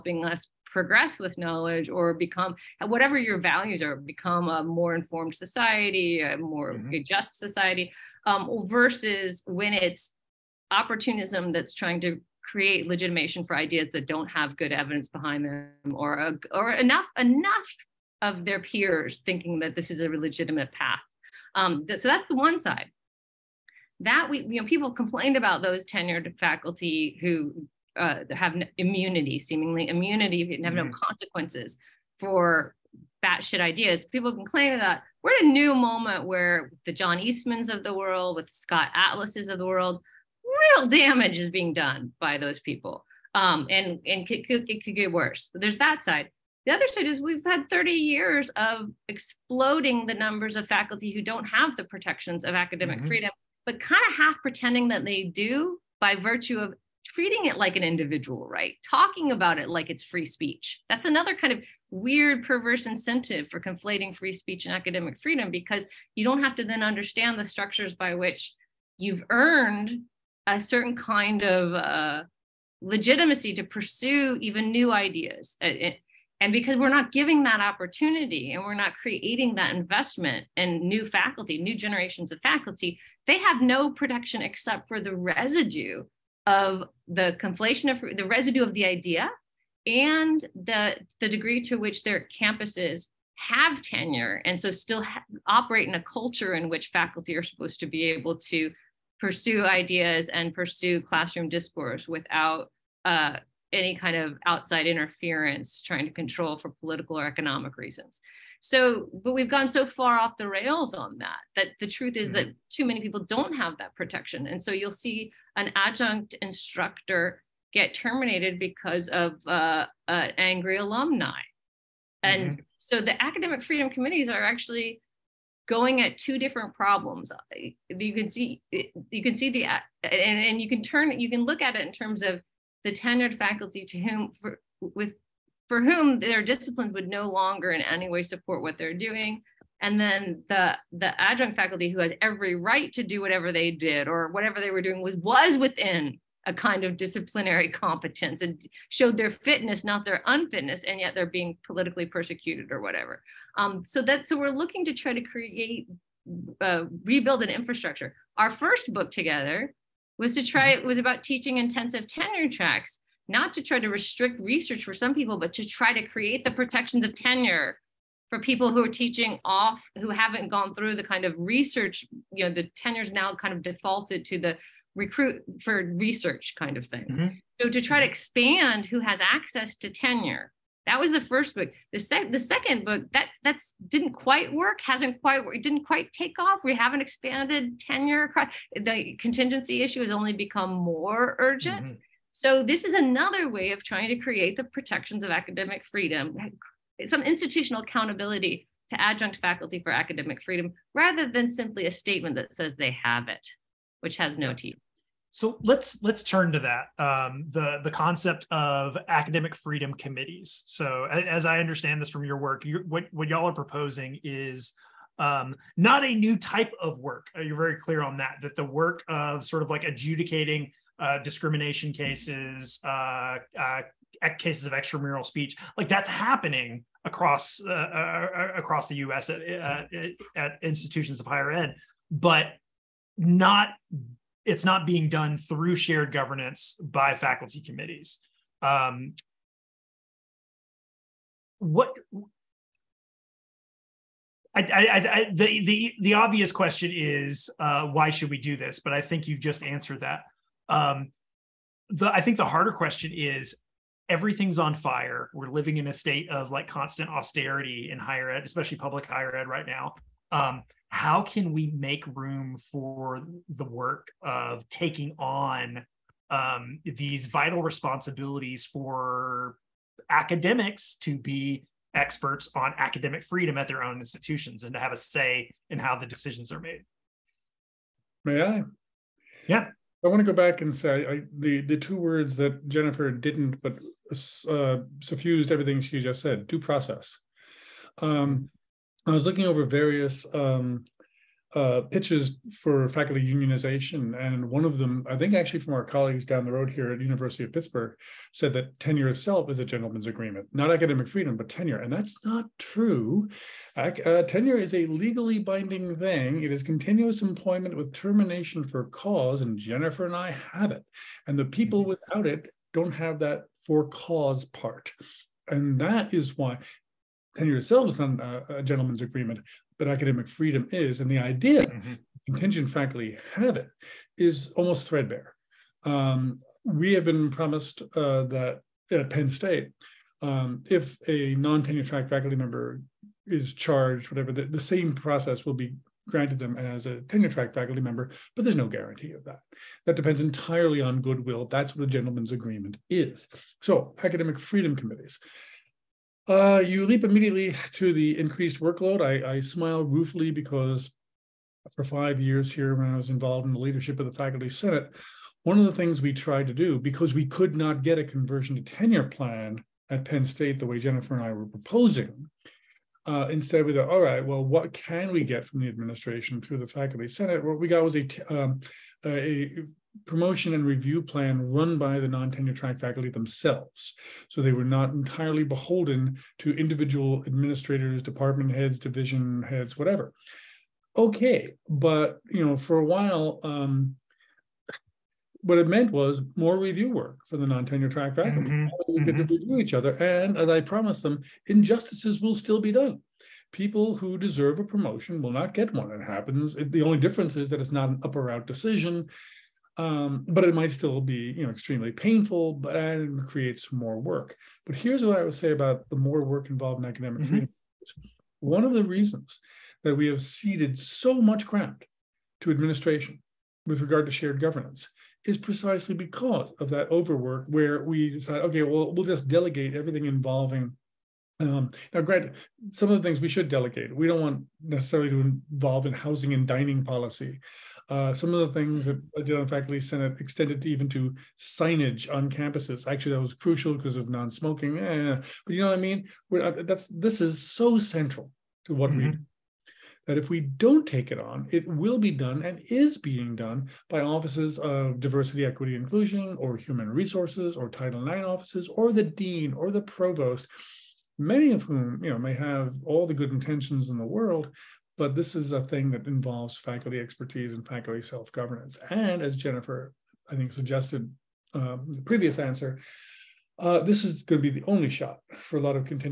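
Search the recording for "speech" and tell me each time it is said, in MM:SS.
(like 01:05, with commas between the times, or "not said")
01:00, 01:04, 03:45.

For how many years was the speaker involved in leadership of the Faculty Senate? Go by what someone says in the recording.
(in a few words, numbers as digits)
5.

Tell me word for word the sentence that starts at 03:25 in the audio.
So let's let's turn to that um, the the concept of academic freedom committees.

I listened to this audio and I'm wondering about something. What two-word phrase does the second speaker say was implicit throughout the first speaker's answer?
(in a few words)
due process.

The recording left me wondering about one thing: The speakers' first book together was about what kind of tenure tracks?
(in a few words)
teaching intensive.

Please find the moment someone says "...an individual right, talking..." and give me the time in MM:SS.
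00:57.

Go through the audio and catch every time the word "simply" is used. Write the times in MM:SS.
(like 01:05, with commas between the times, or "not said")
03:21.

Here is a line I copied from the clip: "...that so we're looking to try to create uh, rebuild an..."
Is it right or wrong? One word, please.
right.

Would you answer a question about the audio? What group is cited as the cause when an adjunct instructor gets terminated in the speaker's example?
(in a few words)
angry alumni.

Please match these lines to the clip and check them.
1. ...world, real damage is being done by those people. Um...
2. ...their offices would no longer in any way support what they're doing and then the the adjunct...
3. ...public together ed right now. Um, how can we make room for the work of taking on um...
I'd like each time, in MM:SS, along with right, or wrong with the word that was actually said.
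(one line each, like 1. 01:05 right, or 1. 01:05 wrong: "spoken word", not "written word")
1. 00:39 right
2. 02:16 wrong: "disciplines", not "offices"
3. 04:18 wrong: "higher", not "together".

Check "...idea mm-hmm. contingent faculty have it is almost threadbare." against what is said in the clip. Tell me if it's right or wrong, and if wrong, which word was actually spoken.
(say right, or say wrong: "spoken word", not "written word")
right.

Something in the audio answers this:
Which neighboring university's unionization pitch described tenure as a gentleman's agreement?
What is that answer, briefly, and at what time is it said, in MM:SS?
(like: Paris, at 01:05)
University of Pittsburgh, at 04:57.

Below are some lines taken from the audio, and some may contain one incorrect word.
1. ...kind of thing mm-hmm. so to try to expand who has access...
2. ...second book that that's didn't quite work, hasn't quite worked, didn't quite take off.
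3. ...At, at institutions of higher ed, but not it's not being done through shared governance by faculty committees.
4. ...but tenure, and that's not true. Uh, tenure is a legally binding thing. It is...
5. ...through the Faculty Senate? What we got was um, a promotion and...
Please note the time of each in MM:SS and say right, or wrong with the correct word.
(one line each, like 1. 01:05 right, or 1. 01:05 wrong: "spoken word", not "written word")
1. 02:56 right
2. 03:02 right
3. 03:49 right
4. 05:01 right
5. 06:06 right.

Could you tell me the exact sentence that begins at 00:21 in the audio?
Um, th so that's the one side.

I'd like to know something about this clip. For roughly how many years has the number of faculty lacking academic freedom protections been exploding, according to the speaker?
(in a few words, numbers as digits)
30 years.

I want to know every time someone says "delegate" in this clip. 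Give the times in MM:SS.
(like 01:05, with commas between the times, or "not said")
06:59, 07:03.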